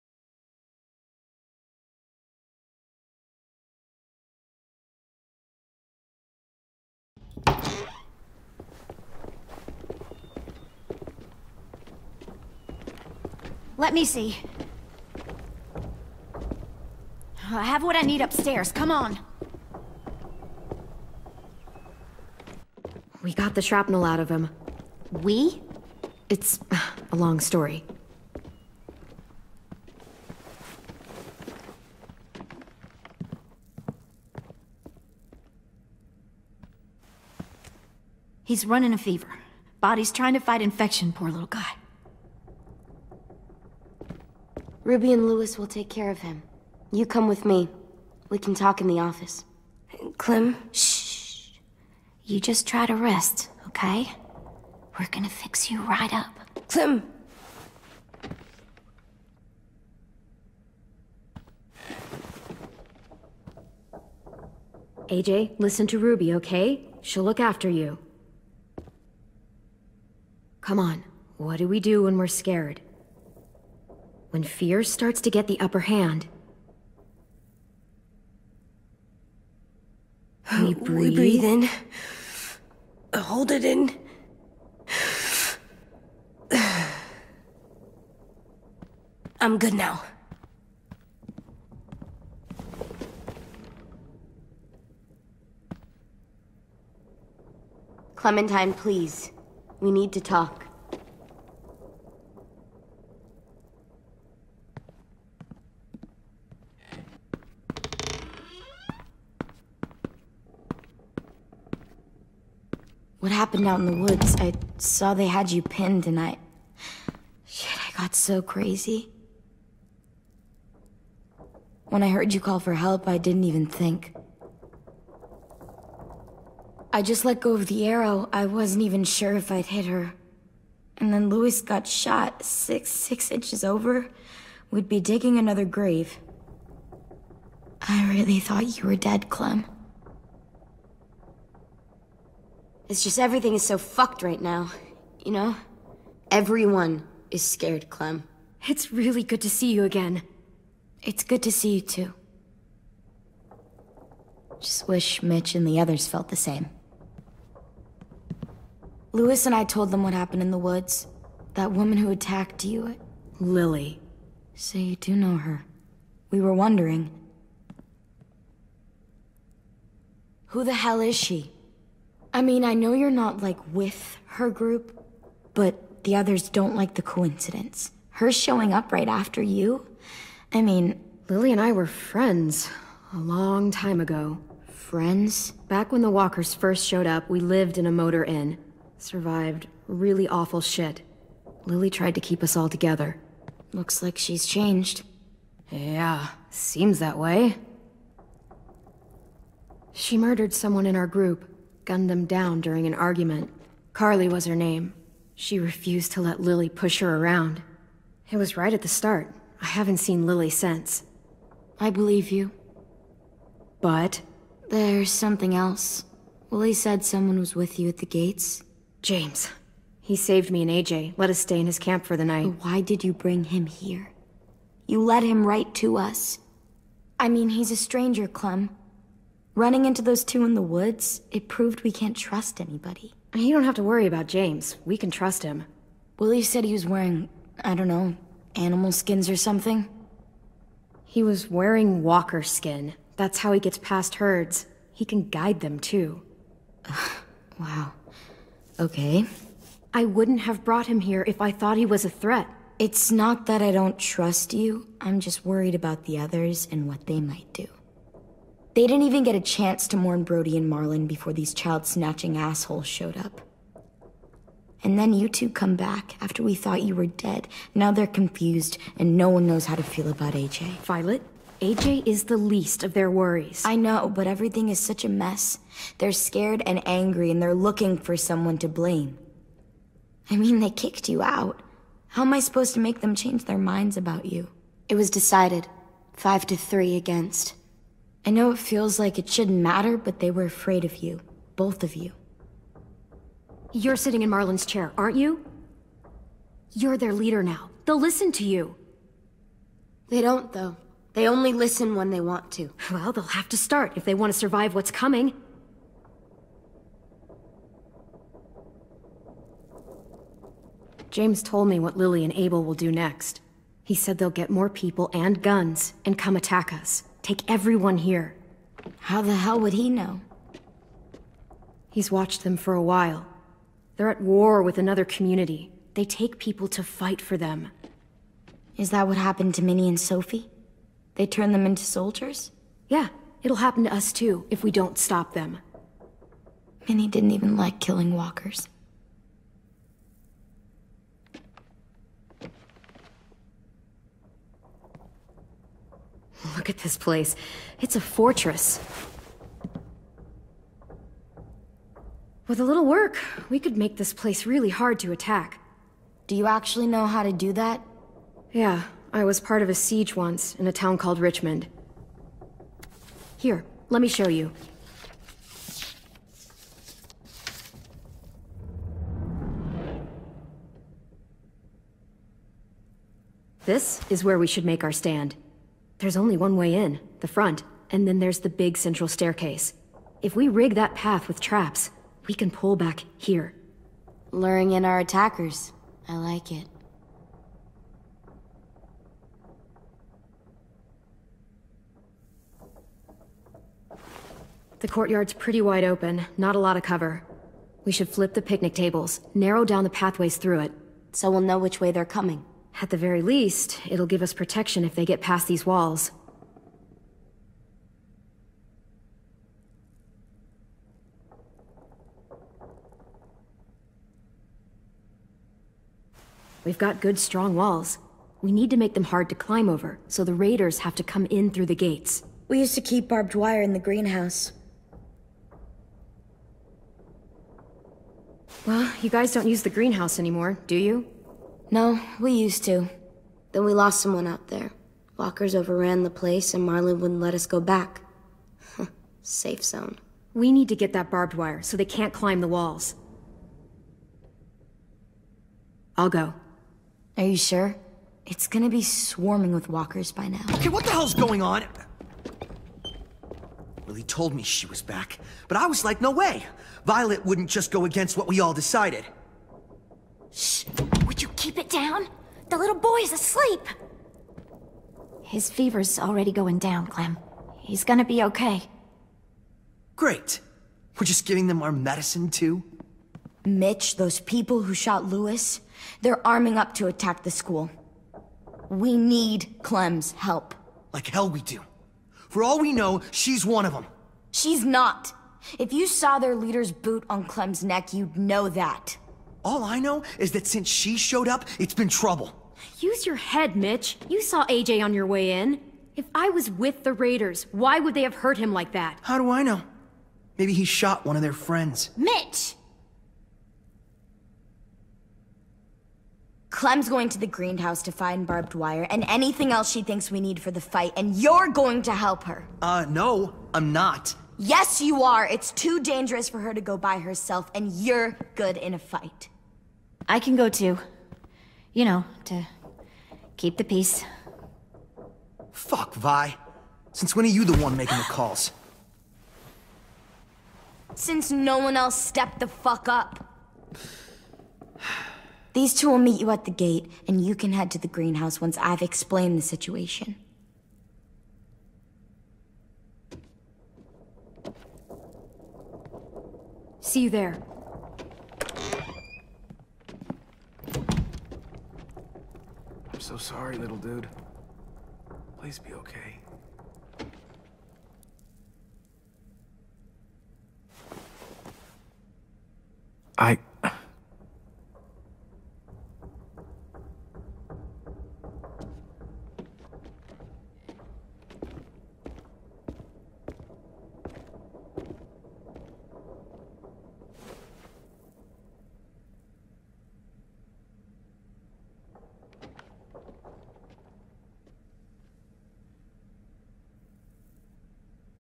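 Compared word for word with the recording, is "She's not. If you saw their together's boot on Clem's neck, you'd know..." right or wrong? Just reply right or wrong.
wrong.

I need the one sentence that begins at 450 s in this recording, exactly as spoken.
Okay, what the hell's going on?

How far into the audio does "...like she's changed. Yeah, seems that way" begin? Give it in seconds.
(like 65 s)
194 s.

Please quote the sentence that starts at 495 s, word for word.
If I was with the Raiders, why would they have hurt him like that?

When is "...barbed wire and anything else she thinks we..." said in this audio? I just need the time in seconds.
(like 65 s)
508 s.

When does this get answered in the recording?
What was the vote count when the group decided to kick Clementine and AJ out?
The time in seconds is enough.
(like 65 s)
286 s.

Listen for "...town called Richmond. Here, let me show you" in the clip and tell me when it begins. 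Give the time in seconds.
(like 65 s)
360 s.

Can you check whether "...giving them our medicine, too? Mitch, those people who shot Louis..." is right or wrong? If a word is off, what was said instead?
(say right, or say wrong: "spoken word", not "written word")
right.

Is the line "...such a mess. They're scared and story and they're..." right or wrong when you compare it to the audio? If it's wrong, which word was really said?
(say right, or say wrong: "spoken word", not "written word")
wrong: "angry", not "story".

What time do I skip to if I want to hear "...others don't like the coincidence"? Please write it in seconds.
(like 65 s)
176 s.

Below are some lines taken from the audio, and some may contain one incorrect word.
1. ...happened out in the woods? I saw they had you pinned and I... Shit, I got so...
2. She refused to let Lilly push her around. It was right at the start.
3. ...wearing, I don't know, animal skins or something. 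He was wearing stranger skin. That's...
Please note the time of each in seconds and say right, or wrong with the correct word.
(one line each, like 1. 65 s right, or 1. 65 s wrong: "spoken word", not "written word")
1. 113 s right
2. 205 s right
3. 236 s wrong: "walker", not "stranger".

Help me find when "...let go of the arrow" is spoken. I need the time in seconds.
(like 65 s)
127 s.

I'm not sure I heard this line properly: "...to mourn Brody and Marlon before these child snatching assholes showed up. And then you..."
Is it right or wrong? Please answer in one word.
right.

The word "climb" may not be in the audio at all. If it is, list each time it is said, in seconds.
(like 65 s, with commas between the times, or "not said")
419 s, 442 s.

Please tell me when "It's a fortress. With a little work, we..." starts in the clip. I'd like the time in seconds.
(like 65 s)
347 s.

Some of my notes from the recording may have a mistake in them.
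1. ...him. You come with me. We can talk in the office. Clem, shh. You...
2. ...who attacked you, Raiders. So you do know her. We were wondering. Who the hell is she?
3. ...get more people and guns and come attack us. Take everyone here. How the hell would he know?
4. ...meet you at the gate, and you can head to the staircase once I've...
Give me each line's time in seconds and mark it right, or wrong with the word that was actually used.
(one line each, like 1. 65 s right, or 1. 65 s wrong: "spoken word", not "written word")
1. 46 s right
2. 161 s wrong: "Lilly", not "Raiders"
3. 314 s right
4. 535 s wrong: "greenhouse", not "staircase".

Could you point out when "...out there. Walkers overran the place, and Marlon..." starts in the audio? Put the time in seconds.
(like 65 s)
434 s.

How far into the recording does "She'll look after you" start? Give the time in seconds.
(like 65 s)
67 s.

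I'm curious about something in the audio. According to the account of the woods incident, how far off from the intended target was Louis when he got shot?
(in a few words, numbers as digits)
6 inches.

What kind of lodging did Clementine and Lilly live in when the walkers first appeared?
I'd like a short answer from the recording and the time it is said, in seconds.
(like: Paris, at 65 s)
Motor inn, at 187 s.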